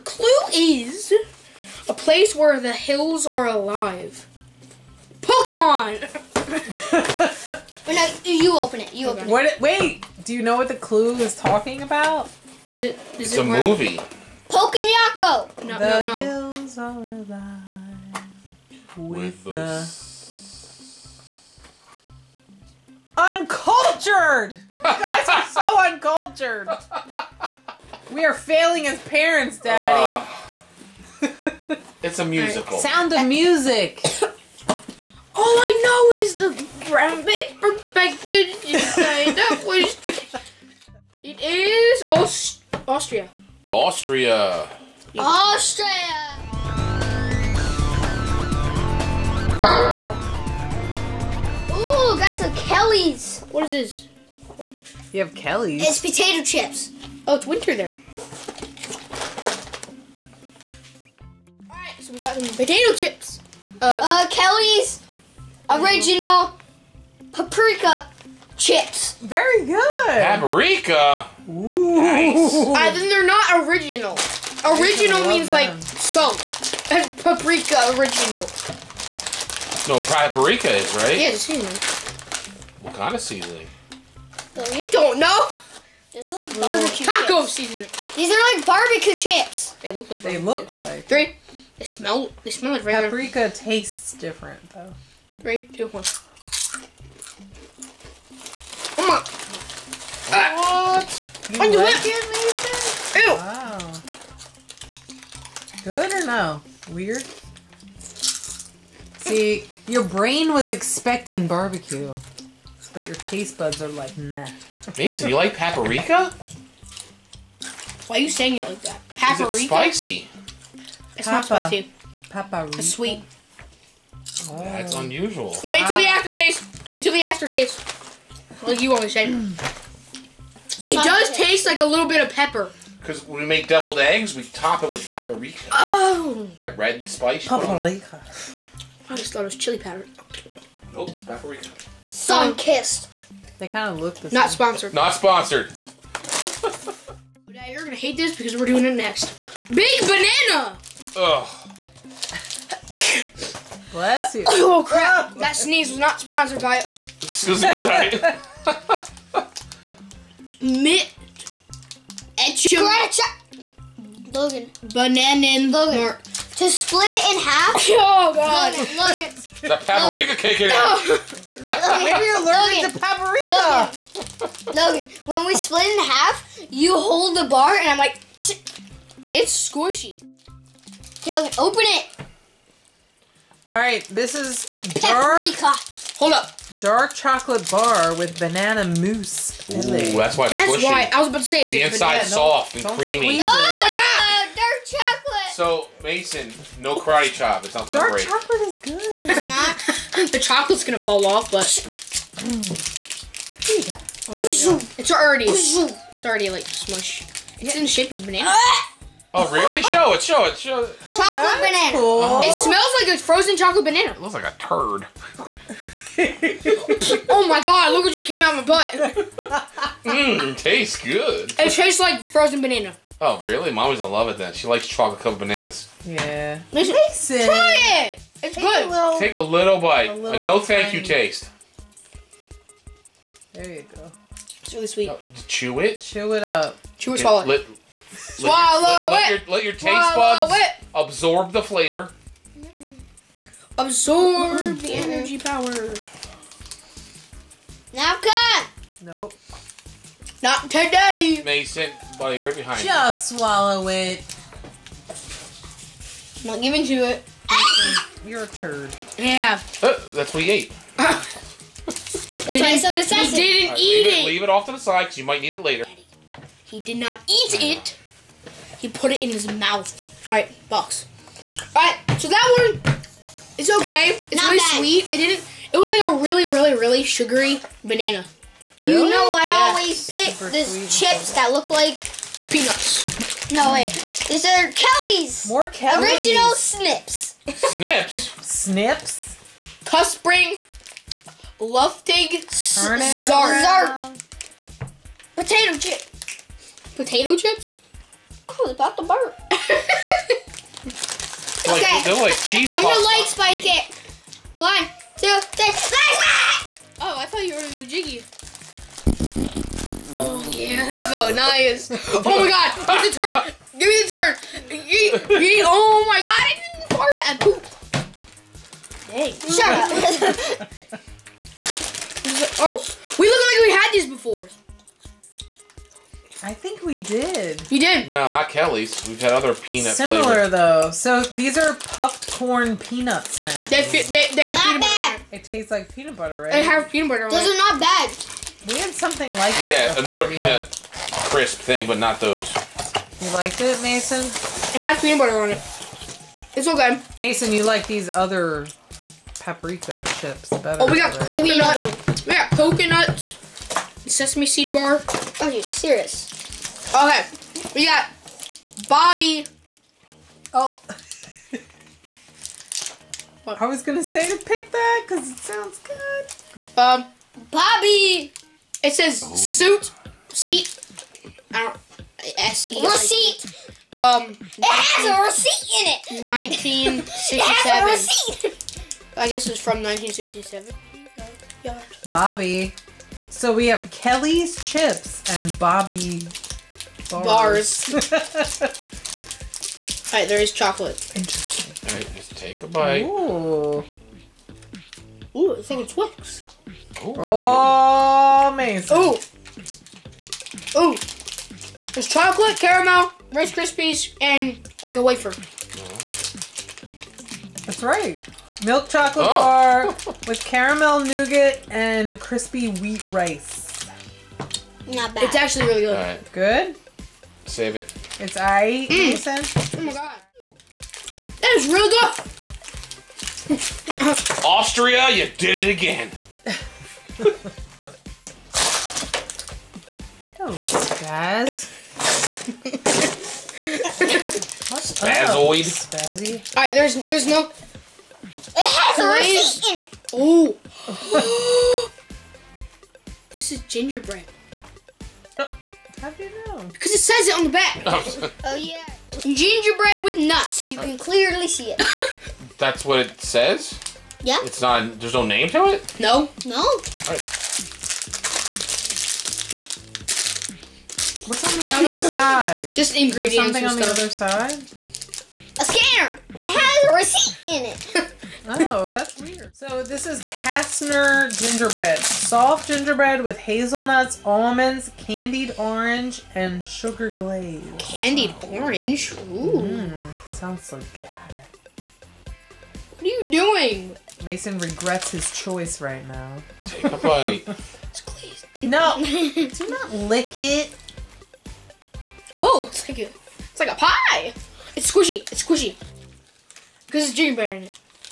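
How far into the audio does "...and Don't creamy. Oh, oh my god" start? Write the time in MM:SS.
03:12.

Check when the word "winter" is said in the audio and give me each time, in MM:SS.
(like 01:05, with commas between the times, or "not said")
00:57.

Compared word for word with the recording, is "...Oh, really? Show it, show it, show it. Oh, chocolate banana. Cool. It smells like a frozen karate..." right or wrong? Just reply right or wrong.
wrong.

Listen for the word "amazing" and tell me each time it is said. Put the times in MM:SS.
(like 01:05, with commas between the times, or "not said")
06:38.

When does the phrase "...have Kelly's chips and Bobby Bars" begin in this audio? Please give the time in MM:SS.
06:23.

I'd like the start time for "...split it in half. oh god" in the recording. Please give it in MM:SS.
02:46.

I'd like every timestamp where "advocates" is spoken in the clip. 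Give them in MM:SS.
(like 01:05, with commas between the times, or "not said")
not said.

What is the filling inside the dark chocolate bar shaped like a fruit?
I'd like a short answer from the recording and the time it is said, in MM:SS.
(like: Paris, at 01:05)
Banana mousse, at 03:08.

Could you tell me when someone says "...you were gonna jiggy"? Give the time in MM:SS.
05:07.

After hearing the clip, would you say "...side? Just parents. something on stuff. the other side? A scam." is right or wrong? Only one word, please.
wrong.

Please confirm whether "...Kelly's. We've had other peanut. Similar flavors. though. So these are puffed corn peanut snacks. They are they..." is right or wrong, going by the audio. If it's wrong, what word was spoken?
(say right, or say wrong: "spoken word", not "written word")
right.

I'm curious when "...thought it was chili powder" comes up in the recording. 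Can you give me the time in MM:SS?
02:19.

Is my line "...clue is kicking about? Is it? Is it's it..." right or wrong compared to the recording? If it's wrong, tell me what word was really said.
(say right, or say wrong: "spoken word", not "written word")
wrong: "talking", not "kicking".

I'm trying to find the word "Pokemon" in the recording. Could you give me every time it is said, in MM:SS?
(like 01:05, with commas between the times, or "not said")
00:05, 00:14.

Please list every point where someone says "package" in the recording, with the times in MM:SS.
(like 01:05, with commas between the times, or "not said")
00:37.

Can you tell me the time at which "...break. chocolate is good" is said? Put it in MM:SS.
03:18.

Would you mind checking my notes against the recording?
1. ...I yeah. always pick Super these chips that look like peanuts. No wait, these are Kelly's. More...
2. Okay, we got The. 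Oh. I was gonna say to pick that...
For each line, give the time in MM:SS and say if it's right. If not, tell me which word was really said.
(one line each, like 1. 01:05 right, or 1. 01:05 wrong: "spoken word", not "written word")
1. 04:39 right
2. 05:56 wrong: "Bobby", not "The".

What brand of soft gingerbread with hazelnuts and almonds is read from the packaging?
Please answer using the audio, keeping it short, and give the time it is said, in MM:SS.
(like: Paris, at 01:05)
Kastner, at 07:50.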